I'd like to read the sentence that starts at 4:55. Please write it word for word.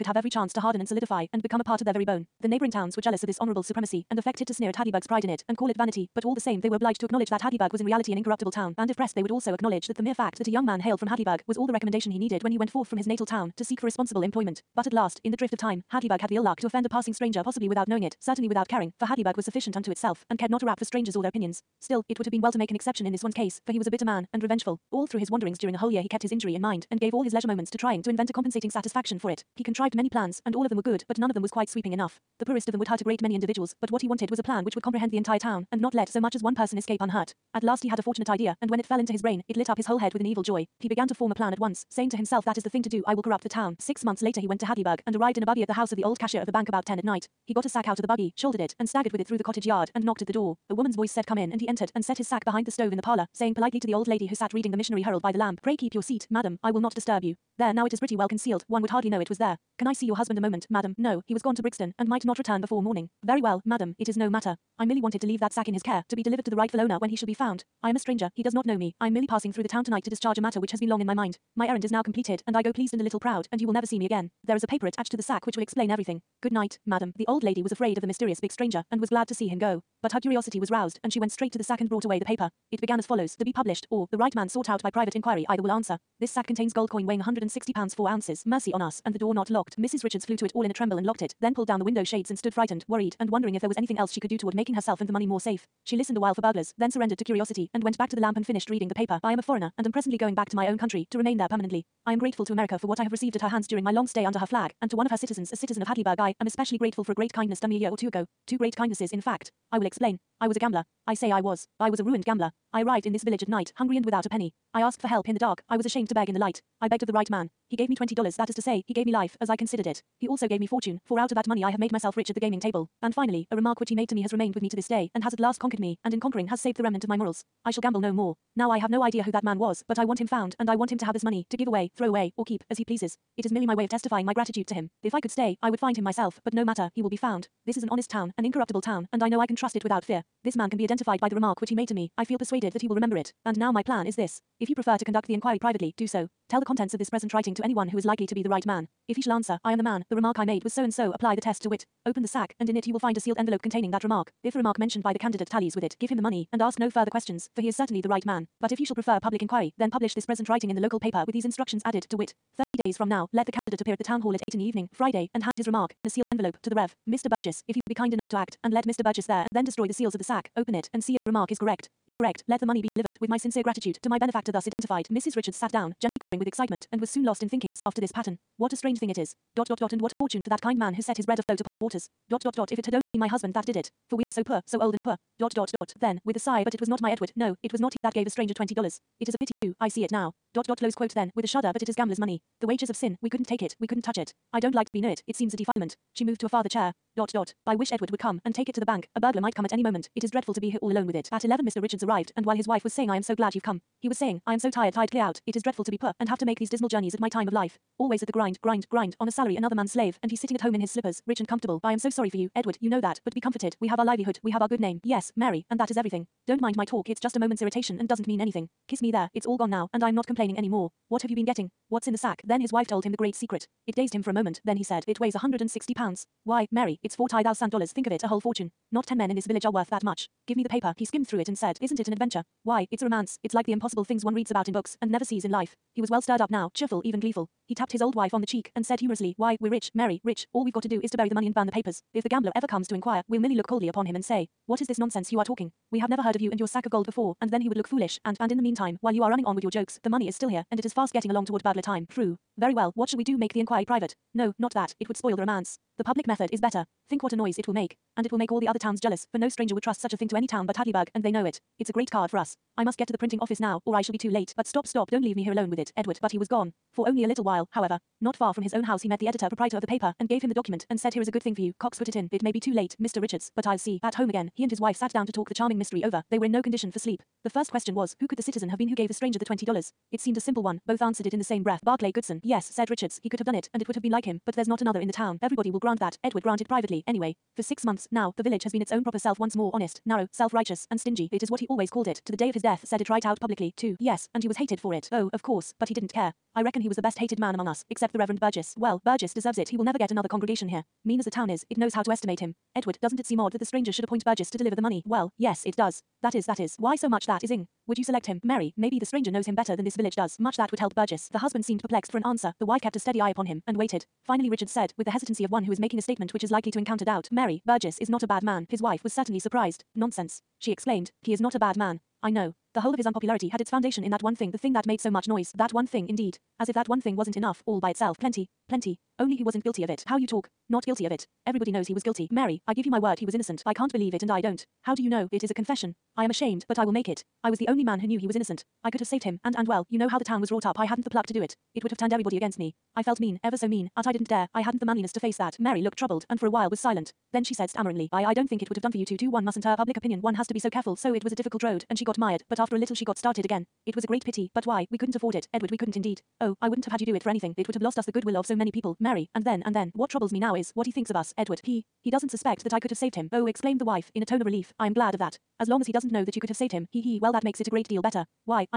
Oh, of course, but he didn't care.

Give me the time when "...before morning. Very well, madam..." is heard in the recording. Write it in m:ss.
1:02.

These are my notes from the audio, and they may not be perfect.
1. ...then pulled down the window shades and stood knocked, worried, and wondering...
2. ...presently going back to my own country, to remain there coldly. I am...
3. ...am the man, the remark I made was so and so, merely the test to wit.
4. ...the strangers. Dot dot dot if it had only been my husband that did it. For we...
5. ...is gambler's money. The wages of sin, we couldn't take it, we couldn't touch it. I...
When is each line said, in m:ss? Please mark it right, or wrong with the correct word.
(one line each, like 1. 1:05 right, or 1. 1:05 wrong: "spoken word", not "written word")
1. 1:31 wrong: "frightened", not "knocked"
2. 1:39 wrong: "permanently", not "coldly"
3. 2:29 wrong: "apply", not "merely"
4. 3:01 wrong: "waters", not "strangers"
5. 3:11 right.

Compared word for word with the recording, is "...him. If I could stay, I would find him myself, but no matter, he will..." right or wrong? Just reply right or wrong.
right.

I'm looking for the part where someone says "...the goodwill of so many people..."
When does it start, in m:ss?
5:58.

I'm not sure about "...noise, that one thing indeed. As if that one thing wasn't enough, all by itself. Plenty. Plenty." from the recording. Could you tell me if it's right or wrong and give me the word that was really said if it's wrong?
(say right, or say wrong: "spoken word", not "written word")
right.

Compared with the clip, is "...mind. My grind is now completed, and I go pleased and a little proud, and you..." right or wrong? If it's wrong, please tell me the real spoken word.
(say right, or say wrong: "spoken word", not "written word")
wrong: "errand", not "grind".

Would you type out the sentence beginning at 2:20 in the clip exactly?
This man can be identified by the remark which he made to me, I feel persuaded that he will remember it.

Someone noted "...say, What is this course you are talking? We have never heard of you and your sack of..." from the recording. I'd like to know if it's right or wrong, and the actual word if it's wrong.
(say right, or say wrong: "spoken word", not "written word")
wrong: "nonsense", not "course".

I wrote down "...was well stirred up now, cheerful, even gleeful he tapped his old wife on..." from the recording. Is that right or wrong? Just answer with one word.
right.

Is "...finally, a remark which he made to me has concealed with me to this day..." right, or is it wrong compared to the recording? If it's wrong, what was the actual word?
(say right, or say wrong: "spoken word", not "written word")
wrong: "remained", not "concealed".